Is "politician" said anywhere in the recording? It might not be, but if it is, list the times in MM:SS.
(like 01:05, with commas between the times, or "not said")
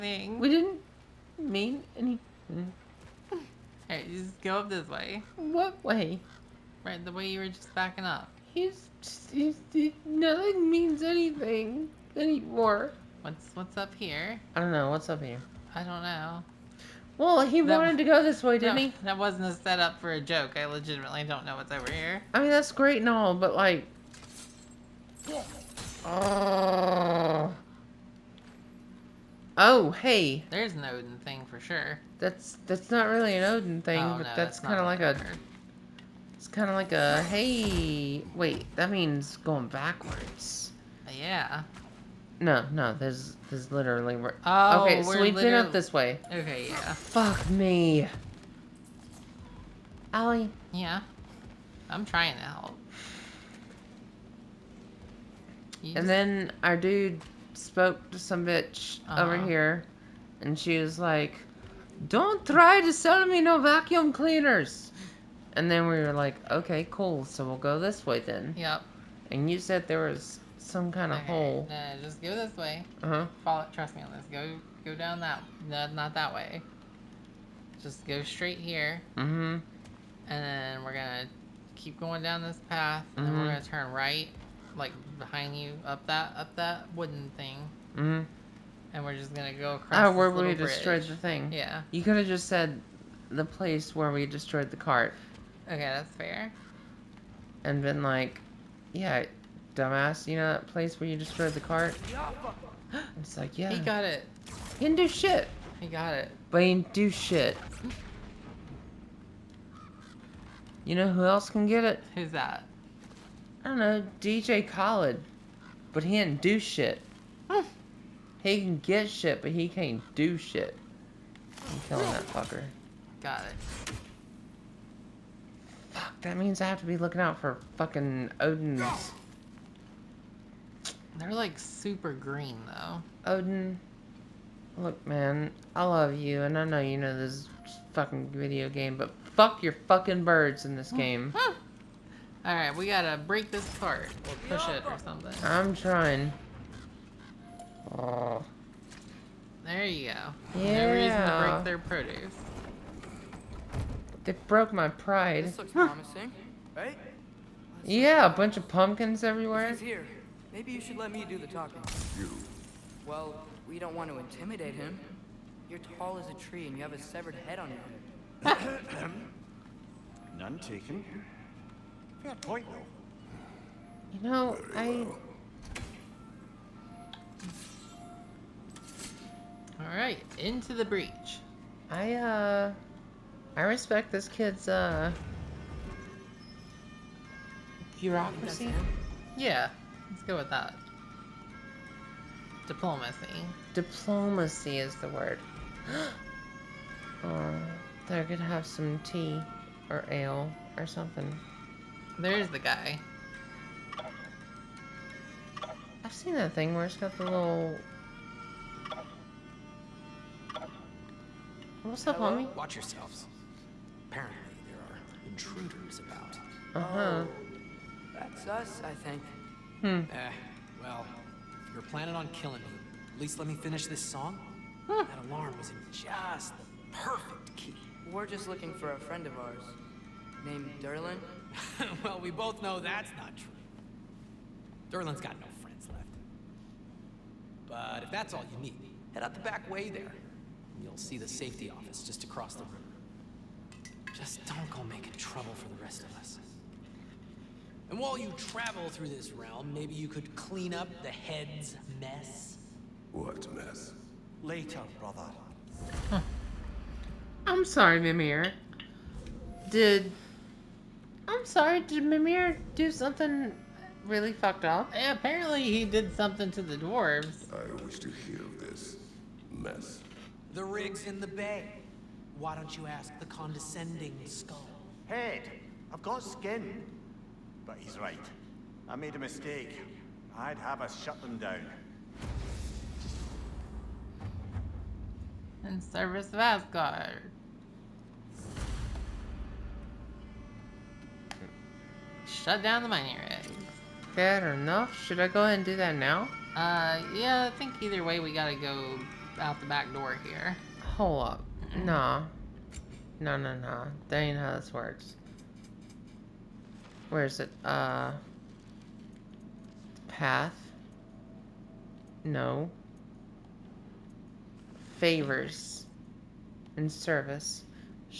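not said.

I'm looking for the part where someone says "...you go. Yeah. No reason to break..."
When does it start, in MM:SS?
02:29.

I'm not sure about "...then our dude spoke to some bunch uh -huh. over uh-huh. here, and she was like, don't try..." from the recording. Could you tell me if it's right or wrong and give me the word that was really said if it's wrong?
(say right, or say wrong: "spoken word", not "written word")
wrong: "bitch", not "bunch".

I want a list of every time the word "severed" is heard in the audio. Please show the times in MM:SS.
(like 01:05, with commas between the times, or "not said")
02:46.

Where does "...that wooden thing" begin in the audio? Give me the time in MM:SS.
01:26.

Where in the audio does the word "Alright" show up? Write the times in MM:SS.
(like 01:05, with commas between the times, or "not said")
02:22, 02:59.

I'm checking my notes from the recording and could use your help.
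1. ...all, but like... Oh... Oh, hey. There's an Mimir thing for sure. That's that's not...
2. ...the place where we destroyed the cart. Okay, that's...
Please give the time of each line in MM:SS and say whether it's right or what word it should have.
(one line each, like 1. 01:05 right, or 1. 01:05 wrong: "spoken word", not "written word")
1. 00:23 wrong: "Odin", not "Mimir"
2. 01:33 right.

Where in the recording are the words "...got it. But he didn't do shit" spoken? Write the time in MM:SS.
01:45.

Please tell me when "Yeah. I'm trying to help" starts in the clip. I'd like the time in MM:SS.
00:50.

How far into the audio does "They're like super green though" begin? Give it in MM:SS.
02:11.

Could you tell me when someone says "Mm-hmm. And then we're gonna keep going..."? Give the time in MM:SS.
01:19.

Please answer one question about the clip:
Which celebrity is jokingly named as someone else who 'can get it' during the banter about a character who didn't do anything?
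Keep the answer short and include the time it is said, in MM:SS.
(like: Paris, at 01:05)
DJ Khaled, at 01:54.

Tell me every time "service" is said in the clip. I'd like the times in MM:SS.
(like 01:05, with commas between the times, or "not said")
04:45, 05:16.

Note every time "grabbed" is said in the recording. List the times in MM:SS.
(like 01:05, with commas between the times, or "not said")
not said.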